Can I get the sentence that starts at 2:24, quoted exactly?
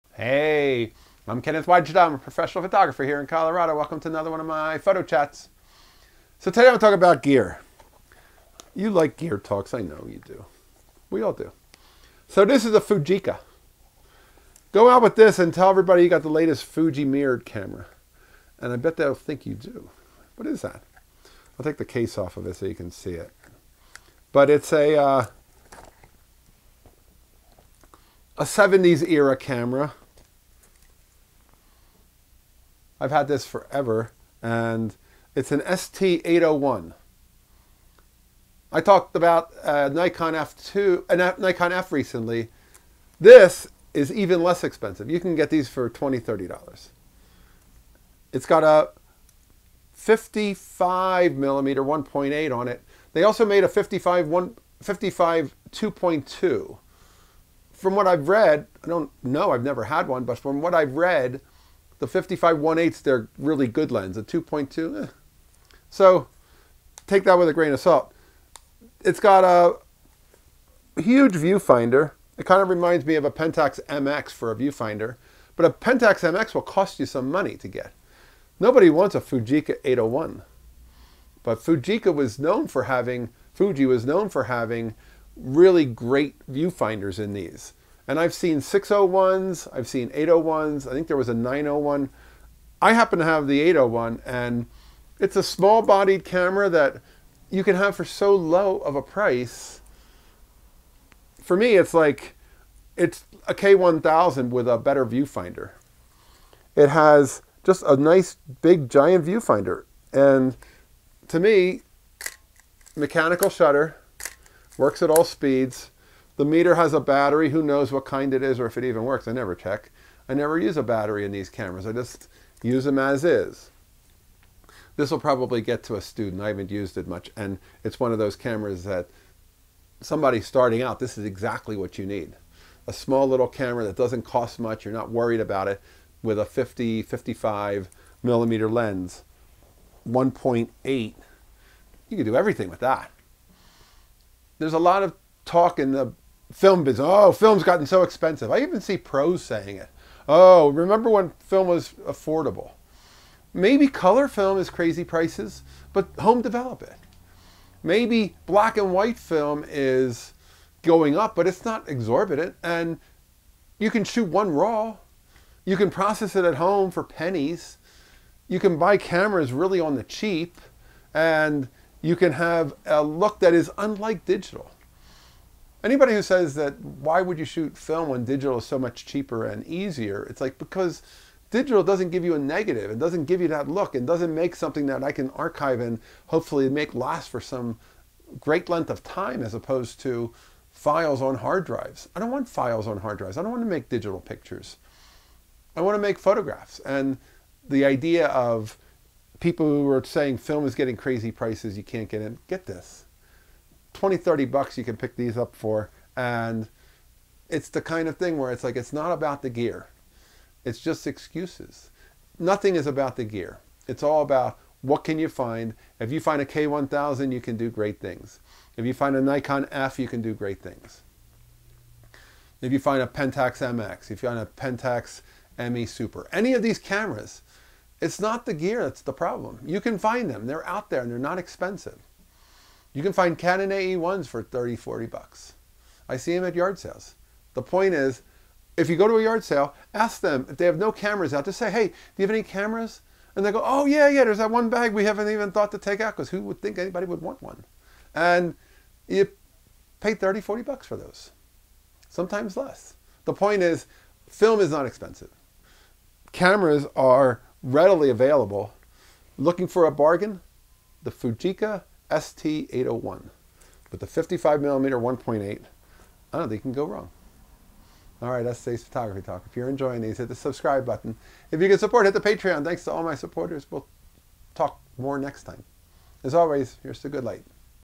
There's a lot of talk in the film business.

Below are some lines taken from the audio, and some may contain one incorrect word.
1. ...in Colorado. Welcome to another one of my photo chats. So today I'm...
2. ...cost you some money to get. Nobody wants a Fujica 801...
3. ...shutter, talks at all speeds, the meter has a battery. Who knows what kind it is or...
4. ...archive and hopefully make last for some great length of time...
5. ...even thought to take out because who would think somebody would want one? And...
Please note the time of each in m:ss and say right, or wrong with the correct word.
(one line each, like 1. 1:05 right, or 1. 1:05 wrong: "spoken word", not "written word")
1. 0:03 right
2. 1:16 right
3. 1:53 wrong: "works", not "talks"
4. 3:05 right
5. 4:05 wrong: "anybody", not "somebody".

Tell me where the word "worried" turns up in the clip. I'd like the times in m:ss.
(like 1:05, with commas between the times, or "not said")
2:15.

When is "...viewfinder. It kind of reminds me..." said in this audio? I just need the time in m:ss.
1:11.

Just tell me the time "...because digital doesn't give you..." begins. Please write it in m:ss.
3:00.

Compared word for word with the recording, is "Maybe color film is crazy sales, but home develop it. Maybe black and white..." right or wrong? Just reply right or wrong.
wrong.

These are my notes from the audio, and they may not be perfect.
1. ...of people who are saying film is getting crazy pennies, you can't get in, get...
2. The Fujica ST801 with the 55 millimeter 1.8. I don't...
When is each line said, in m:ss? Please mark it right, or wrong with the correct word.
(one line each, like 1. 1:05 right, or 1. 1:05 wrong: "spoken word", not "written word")
1. 3:18 wrong: "prices", not "pennies"
2. 4:21 right.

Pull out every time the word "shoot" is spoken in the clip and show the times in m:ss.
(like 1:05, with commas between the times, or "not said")
2:44, 2:57.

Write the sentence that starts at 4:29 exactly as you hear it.
If you're enjoying these, hit the subscribe button.